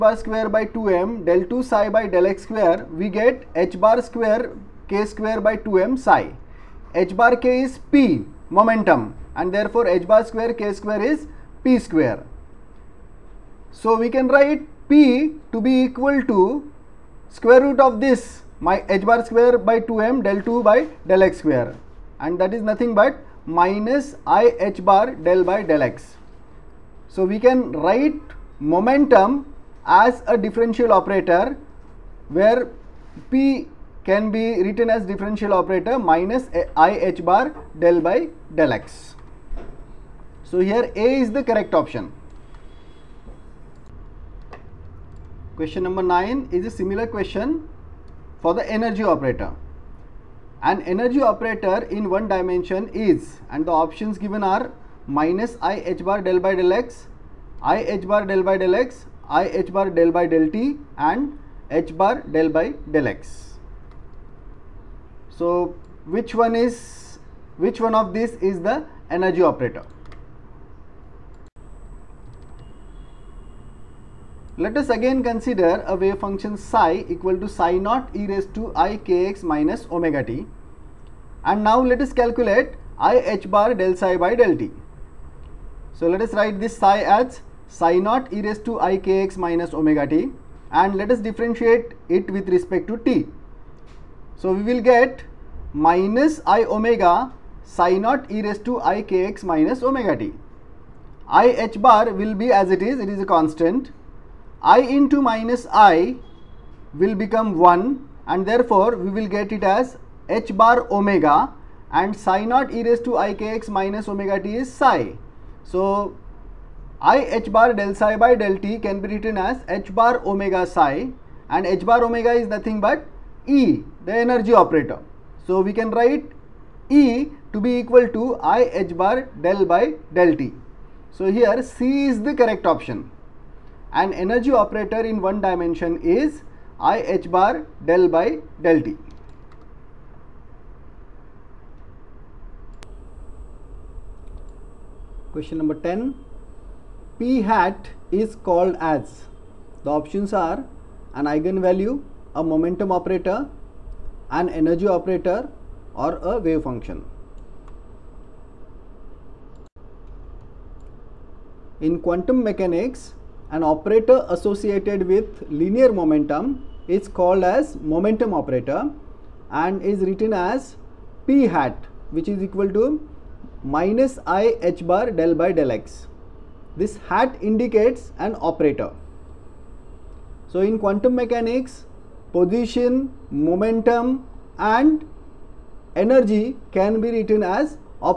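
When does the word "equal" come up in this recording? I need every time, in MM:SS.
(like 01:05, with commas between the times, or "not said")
00:15, 01:17, 02:07, 02:52.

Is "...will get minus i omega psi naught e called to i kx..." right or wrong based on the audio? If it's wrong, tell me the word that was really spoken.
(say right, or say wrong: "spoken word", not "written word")
wrong: "raised", not "called".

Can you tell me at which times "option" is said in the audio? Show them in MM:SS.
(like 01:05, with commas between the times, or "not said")
00:41, 00:53, 02:12, 02:29.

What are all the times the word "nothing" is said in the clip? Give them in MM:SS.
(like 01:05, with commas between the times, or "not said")
00:22, 02:02.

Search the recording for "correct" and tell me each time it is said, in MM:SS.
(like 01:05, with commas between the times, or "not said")
00:41, 02:12.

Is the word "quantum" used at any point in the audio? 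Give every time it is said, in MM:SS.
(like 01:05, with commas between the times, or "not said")
02:41, 03:00.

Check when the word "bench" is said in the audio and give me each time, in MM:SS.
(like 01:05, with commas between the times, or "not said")
not said.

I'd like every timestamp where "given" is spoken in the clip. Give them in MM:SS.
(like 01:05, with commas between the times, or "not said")
00:54.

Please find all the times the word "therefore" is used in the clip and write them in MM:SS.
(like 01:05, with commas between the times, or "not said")
00:09, 01:48.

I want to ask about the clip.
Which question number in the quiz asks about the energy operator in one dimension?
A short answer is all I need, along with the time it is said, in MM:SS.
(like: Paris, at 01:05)
9, at 00:45.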